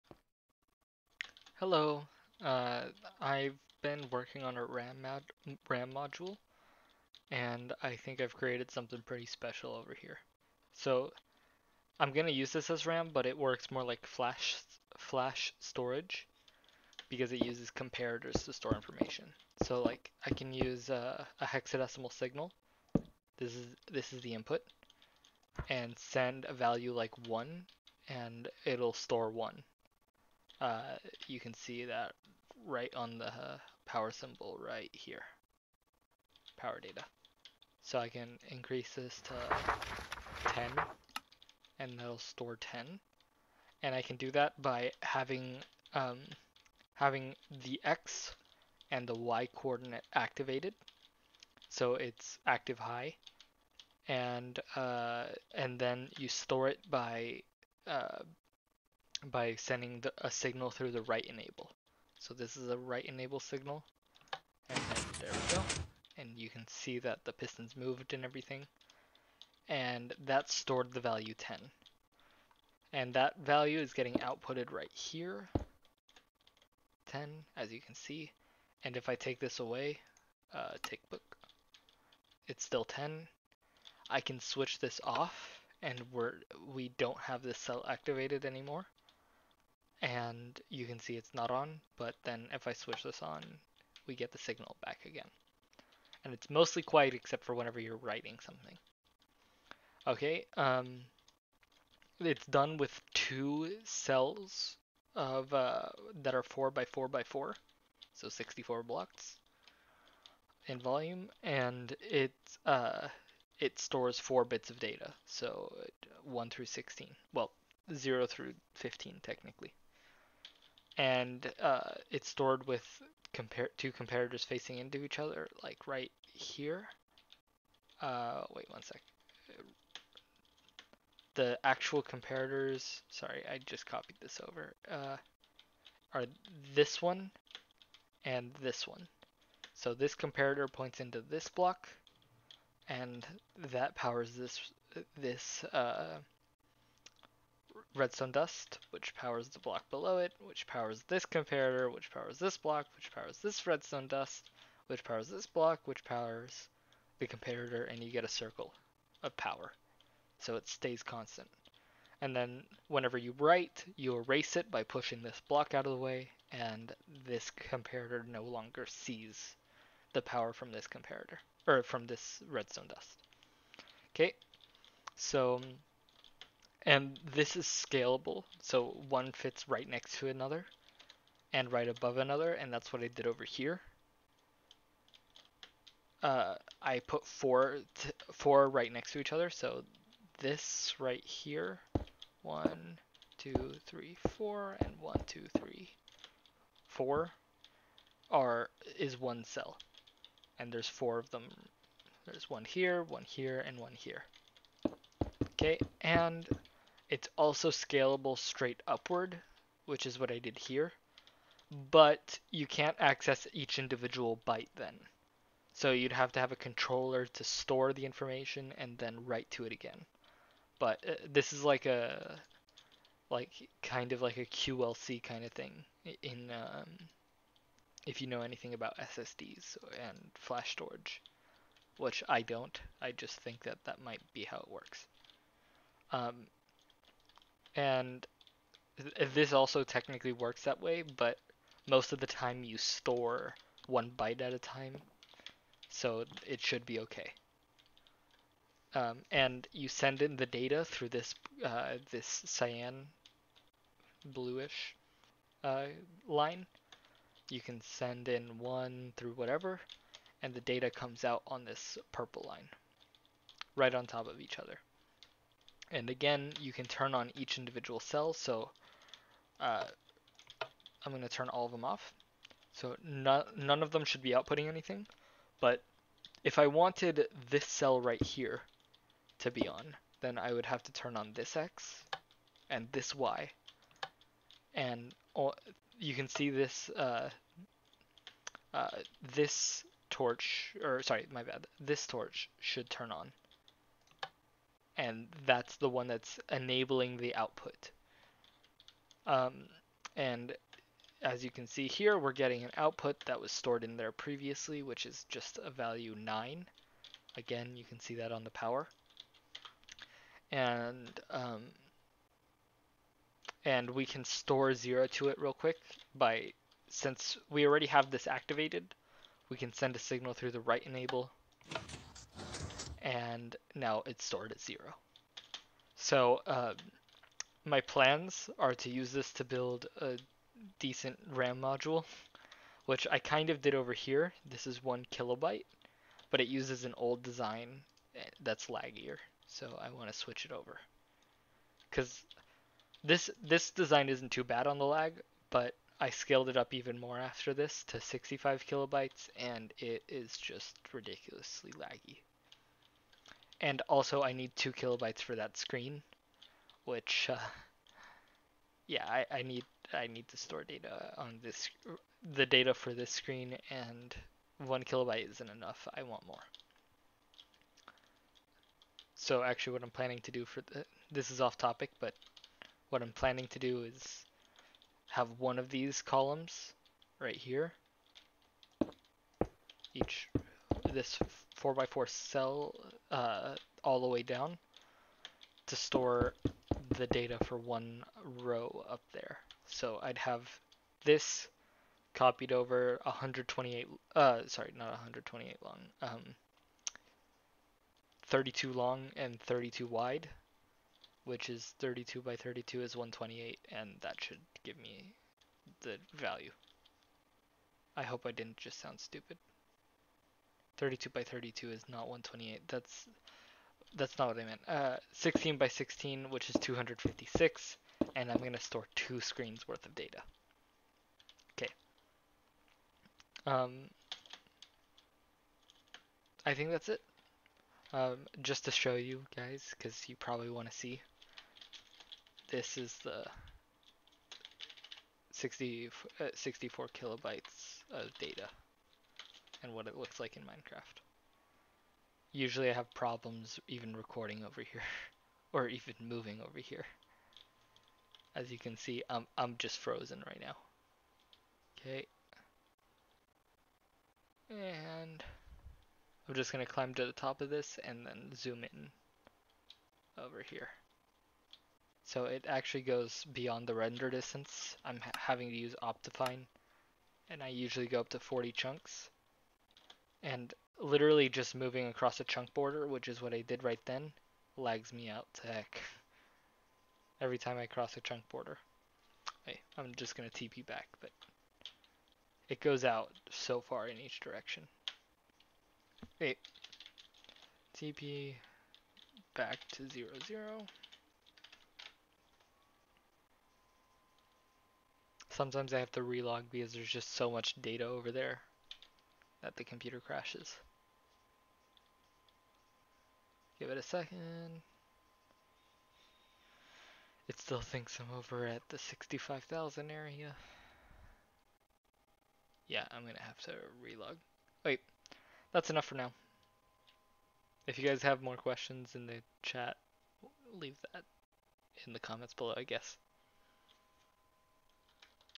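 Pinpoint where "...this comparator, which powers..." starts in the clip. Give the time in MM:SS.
02:31.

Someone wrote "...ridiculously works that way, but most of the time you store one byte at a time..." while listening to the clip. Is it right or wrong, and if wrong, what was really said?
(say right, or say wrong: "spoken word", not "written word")
wrong: "technically", not "ridiculously".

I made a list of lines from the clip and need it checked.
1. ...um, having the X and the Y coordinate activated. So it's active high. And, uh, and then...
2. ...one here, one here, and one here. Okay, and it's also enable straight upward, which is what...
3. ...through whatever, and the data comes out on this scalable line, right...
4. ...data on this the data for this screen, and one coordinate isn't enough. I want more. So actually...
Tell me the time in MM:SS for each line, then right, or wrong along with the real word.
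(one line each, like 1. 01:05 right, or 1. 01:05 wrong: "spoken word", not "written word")
1. 00:45 right
2. 03:22 wrong: "scalable", not "enable"
3. 04:19 wrong: "purple", not "scalable"
4. 06:00 wrong: "kilobyte", not "coordinate".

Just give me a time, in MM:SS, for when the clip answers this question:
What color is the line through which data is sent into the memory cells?
04:12.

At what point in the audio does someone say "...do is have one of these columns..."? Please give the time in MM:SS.
06:13.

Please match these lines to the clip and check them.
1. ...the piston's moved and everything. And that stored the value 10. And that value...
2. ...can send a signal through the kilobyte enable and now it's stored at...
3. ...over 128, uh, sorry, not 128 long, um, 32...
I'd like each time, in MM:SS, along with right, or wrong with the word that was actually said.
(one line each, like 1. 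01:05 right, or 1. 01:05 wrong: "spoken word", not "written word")
1. 01:07 right
2. 05:19 wrong: "write", not "kilobyte"
3. 06:32 right.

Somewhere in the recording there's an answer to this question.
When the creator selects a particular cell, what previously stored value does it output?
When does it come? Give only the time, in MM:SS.
05:06.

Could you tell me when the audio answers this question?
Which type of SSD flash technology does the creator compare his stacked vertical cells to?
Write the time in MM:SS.
03:44.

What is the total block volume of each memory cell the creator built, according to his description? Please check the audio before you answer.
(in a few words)
64 blocks.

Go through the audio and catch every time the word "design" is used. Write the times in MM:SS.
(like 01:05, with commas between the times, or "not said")
05:37, 05:43.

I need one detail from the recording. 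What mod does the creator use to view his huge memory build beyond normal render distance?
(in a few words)
Optifine.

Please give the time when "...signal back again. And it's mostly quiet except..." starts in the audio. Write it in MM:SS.
01:34.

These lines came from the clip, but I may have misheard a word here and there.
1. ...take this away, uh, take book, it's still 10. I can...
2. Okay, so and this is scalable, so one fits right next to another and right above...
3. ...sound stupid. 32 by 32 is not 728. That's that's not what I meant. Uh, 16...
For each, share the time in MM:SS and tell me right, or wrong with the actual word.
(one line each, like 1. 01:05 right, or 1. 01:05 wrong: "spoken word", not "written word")
1. 01:19 right
2. 02:54 right
3. 06:48 wrong: "128", not "728".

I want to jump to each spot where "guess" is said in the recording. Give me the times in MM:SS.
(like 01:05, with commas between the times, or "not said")
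08:42.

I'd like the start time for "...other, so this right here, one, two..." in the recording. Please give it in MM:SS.
03:09.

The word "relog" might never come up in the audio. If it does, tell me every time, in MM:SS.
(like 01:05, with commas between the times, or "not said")
08:16, 08:33.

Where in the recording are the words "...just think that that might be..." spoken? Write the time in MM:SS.
03:53.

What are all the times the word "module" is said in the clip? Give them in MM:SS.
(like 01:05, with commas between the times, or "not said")
00:05, 05:31.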